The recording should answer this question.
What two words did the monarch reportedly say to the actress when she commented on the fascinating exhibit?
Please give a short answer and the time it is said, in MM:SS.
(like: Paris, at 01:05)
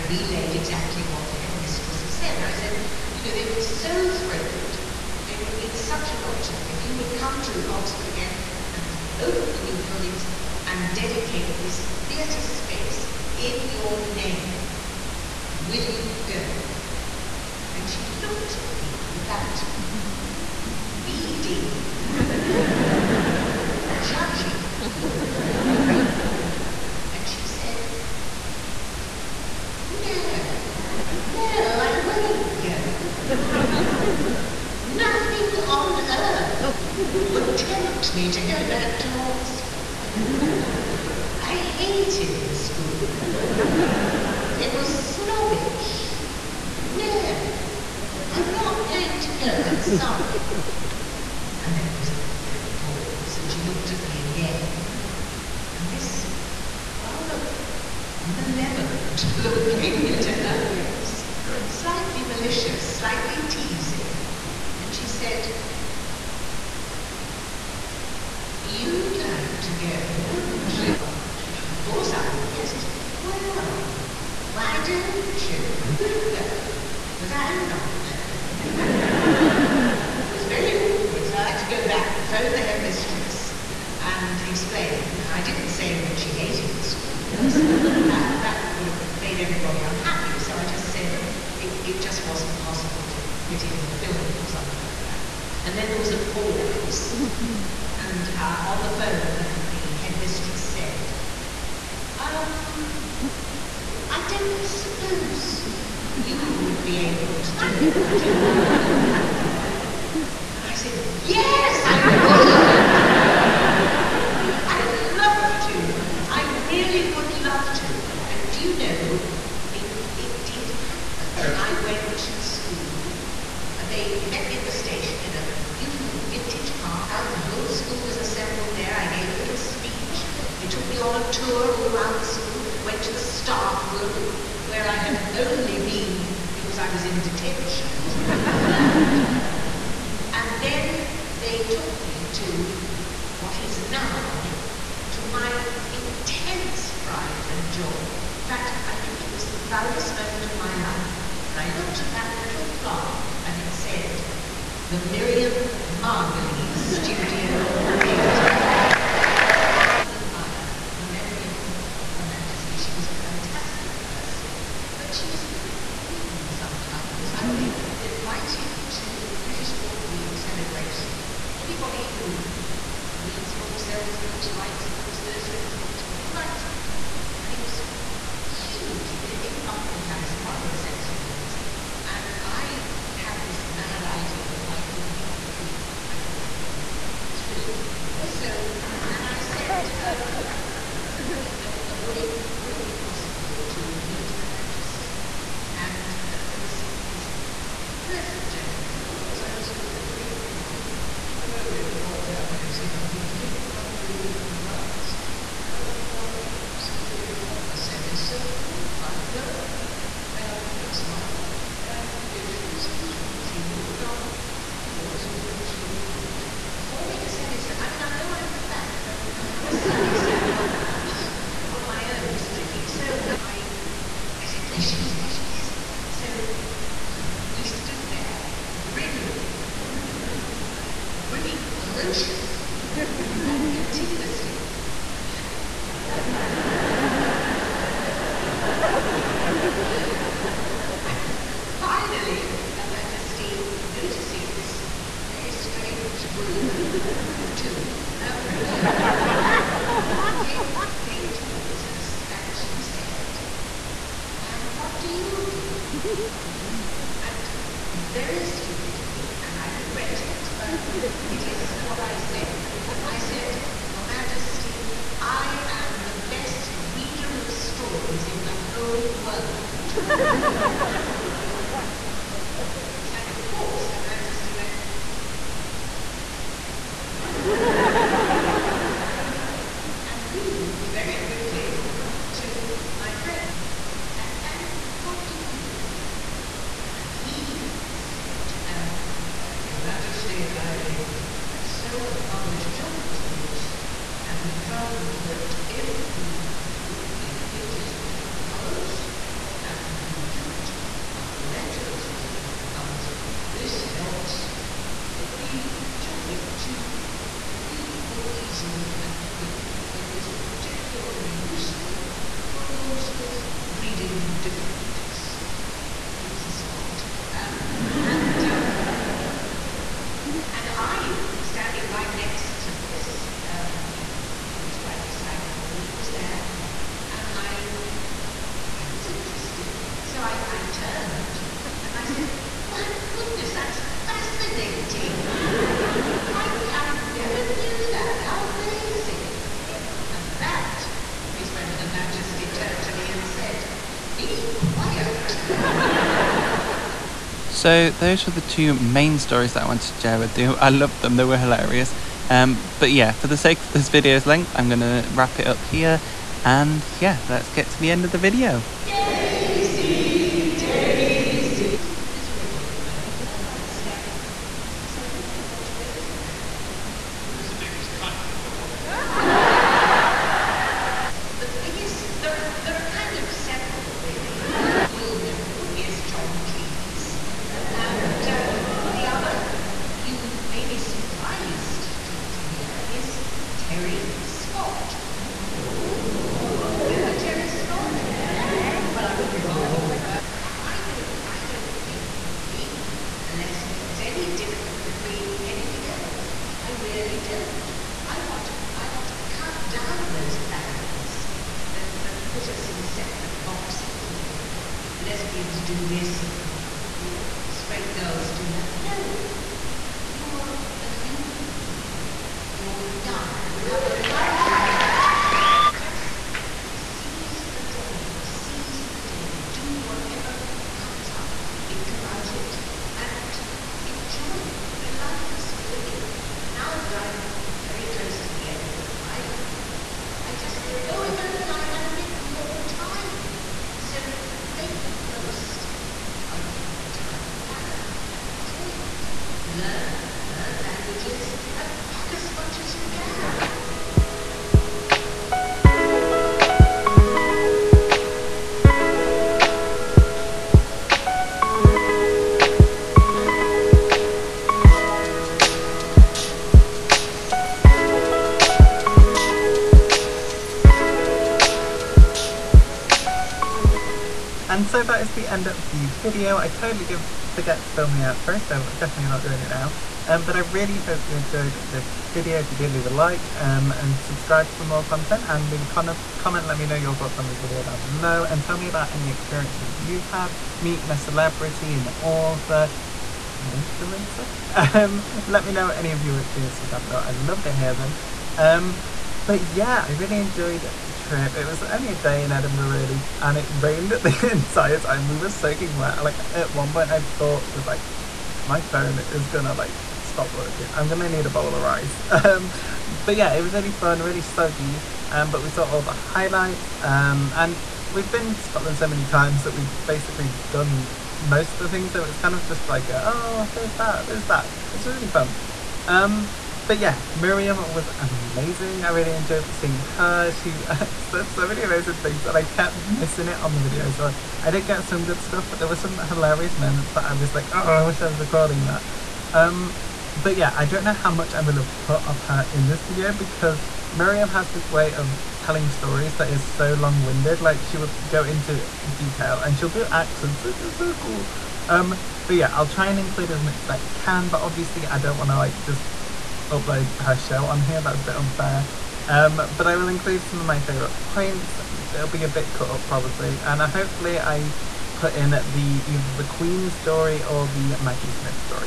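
Be quiet, at 05:44.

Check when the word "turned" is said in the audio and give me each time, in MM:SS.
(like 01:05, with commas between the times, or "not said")
05:30, 05:42.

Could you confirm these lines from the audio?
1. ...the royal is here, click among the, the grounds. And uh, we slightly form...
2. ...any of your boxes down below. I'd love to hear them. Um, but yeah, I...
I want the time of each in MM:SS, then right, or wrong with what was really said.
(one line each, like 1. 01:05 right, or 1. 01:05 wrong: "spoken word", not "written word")
1. 03:21 wrong: "simply", not "slightly"
2. 08:05 wrong: "experiences", not "boxes".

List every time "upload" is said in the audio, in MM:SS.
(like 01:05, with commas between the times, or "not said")
09:06.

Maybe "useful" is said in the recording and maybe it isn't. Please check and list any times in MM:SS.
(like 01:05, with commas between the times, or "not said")
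05:11.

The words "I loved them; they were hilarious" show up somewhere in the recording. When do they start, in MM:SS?
05:50.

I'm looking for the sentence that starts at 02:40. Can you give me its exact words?
admire the memory of, of Her Majesty.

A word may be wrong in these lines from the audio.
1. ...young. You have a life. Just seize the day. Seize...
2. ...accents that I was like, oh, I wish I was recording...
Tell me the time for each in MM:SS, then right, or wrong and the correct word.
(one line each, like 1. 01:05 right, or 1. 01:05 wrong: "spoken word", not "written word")
1. 06:53 right
2. 08:46 wrong: "moments", not "accents".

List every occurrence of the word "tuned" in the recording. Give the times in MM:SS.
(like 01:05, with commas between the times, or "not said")
not said.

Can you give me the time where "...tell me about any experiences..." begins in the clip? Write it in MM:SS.
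07:58.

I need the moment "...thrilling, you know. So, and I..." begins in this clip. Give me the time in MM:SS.
03:07.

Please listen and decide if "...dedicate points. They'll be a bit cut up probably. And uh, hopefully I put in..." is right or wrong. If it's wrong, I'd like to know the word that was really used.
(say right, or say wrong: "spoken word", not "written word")
wrong: "favourite", not "dedicate".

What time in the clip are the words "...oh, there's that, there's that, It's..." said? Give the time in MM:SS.
08:33.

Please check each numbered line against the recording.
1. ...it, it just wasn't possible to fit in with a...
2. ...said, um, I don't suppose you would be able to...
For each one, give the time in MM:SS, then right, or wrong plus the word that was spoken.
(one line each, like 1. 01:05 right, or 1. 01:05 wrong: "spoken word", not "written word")
1. 01:31 right
2. 01:40 right.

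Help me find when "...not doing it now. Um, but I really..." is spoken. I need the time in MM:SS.
07:49.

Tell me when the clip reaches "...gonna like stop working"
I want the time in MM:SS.
08:19.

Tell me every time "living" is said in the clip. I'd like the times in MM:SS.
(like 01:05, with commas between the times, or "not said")
07:05.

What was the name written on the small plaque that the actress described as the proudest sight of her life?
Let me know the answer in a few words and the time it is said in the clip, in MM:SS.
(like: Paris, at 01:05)
The Miriam Margolyes Studio Theatre, at 02:34.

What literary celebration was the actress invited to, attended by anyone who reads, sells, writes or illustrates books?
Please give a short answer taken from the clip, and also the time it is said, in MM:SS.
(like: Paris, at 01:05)
British Book Week, at 02:49.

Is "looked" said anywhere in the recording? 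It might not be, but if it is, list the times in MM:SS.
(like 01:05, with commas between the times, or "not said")
00:18, 02:31.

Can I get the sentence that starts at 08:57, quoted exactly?
Like, she will go into detail and she'll do accents, which is so cool.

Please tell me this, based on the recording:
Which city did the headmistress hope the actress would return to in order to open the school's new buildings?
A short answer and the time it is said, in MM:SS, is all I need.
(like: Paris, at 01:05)
Oxford, at 00:07.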